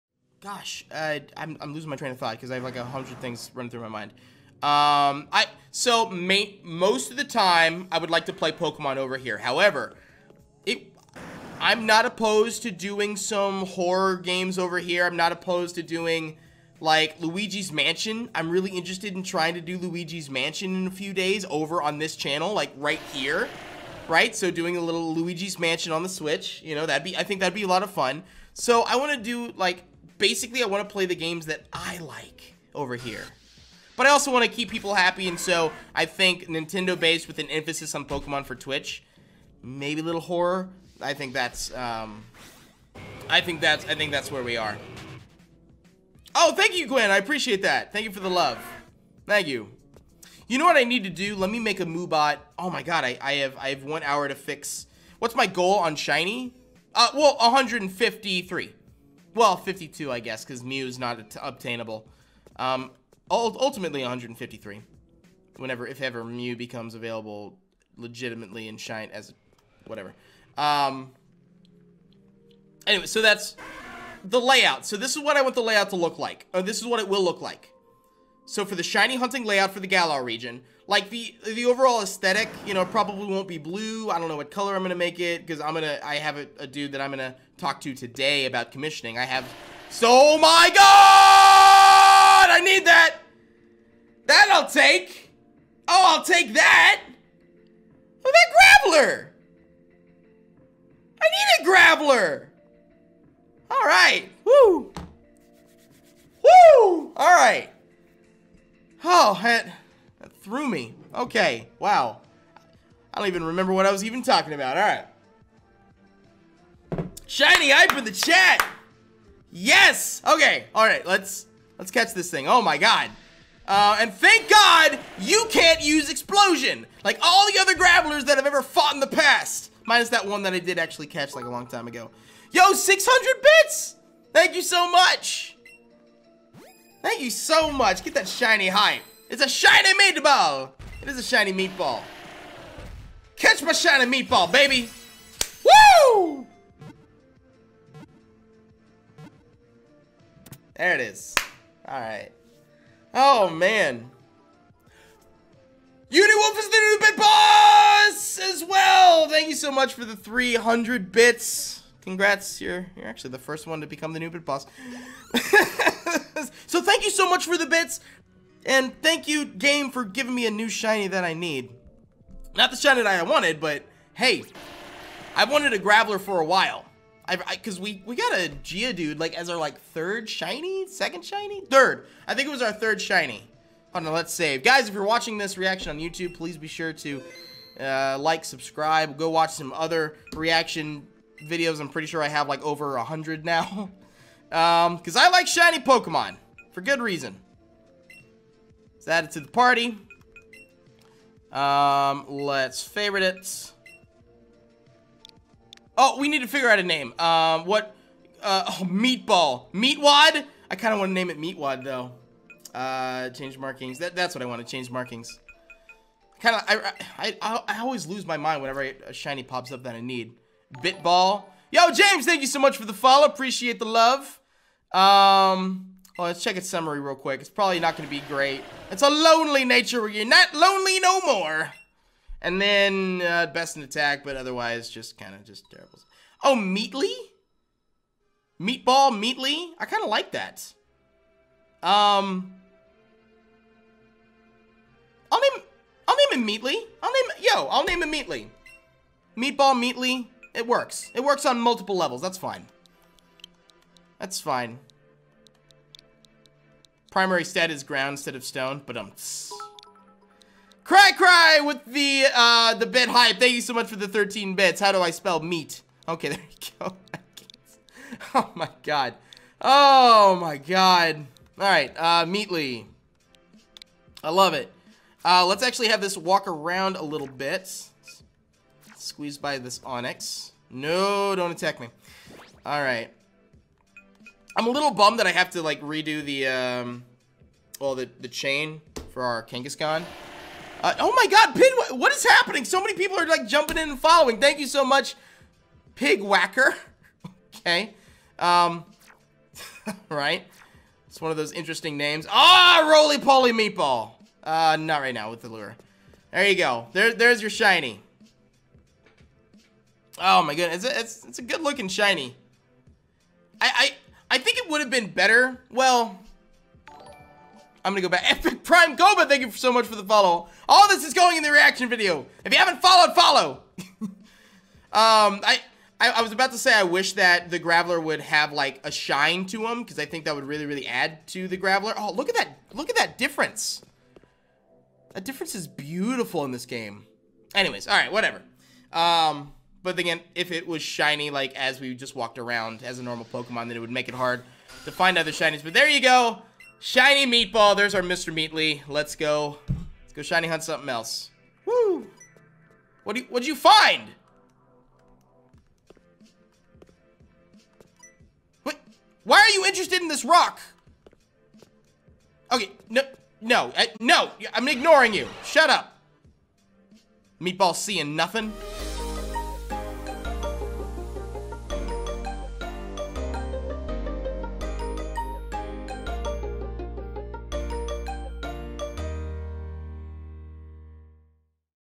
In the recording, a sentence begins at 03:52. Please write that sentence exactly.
And then uh, best in attack, but otherwise just kind of just terrible.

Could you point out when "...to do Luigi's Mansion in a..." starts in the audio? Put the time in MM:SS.
00:19.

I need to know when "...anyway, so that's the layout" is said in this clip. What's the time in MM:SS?
01:12.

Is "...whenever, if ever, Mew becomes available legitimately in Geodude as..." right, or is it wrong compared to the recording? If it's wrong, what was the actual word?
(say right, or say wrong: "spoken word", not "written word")
wrong: "Shine", not "Geodude".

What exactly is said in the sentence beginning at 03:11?
I'm pretty sure I have like over a hundred now.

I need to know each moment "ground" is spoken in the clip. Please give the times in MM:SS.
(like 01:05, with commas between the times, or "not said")
04:17.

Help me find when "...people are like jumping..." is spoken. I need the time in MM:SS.
04:52.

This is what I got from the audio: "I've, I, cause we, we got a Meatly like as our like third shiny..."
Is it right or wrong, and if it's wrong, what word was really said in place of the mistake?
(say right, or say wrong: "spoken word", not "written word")
wrong: "Geodude", not "Meatly".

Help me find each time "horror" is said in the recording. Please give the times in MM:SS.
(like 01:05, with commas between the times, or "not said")
00:13, 00:40.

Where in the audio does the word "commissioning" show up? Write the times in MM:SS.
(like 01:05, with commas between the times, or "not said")
01:28.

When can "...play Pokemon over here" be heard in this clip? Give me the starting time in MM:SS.
00:08.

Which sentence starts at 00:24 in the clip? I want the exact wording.
So doing a little Luigi's Mansion on the Switch, you know, that'd be I think that'd be a lot of fun.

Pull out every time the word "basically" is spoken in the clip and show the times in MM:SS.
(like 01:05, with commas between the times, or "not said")
00:30.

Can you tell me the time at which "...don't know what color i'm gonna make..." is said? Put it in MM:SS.
01:24.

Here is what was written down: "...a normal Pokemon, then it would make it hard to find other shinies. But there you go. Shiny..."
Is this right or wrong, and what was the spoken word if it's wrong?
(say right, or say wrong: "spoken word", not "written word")
right.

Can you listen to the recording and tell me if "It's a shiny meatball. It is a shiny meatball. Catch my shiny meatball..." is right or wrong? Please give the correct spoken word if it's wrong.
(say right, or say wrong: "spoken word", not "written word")
right.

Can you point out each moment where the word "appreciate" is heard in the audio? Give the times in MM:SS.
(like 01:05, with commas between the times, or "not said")
00:47, 03:43.